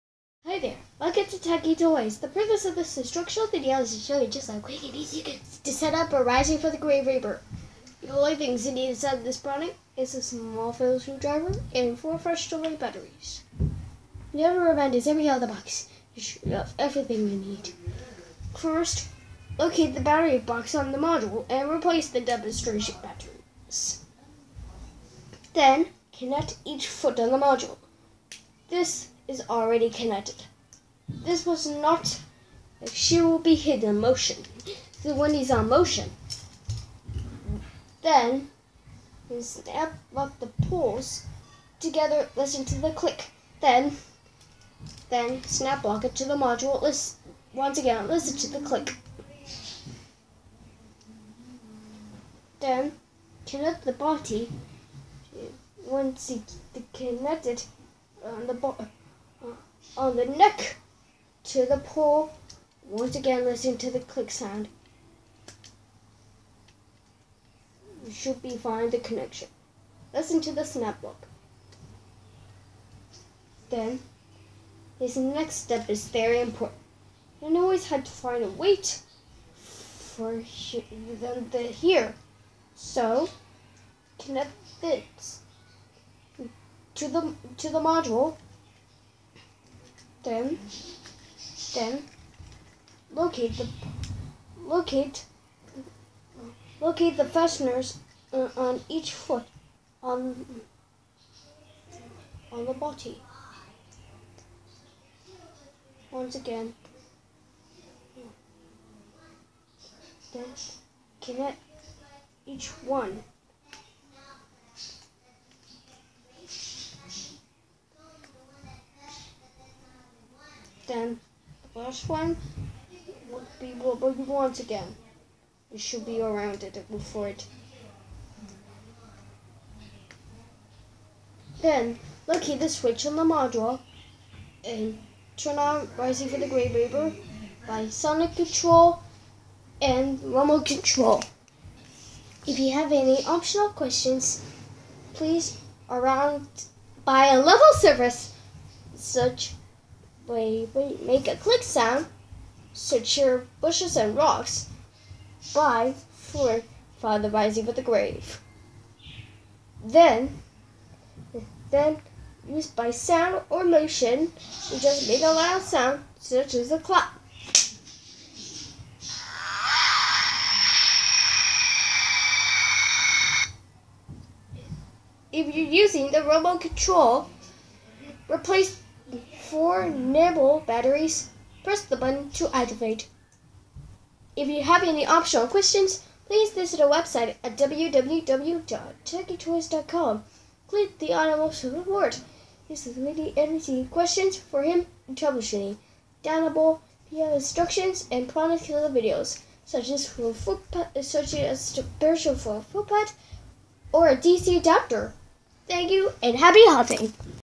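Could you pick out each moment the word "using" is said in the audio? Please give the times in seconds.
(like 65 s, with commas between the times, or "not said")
175 s.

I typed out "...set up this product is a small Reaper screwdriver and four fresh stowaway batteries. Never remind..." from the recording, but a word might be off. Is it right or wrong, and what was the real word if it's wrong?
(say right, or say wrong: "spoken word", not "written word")
wrong: "Phillips", not "Reaper".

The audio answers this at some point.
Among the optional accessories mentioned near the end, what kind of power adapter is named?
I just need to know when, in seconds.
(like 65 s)
204 s.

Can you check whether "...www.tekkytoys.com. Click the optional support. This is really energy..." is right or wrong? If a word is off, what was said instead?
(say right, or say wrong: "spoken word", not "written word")
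wrong: "animal", not "optional".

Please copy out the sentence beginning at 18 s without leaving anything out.
First, locate the battery box on the module and replace the demonstration batteries.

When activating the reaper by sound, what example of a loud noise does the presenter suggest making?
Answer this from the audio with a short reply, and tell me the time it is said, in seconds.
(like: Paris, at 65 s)
A clap, at 166 s.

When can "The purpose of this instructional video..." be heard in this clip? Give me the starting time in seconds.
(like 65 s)
2 s.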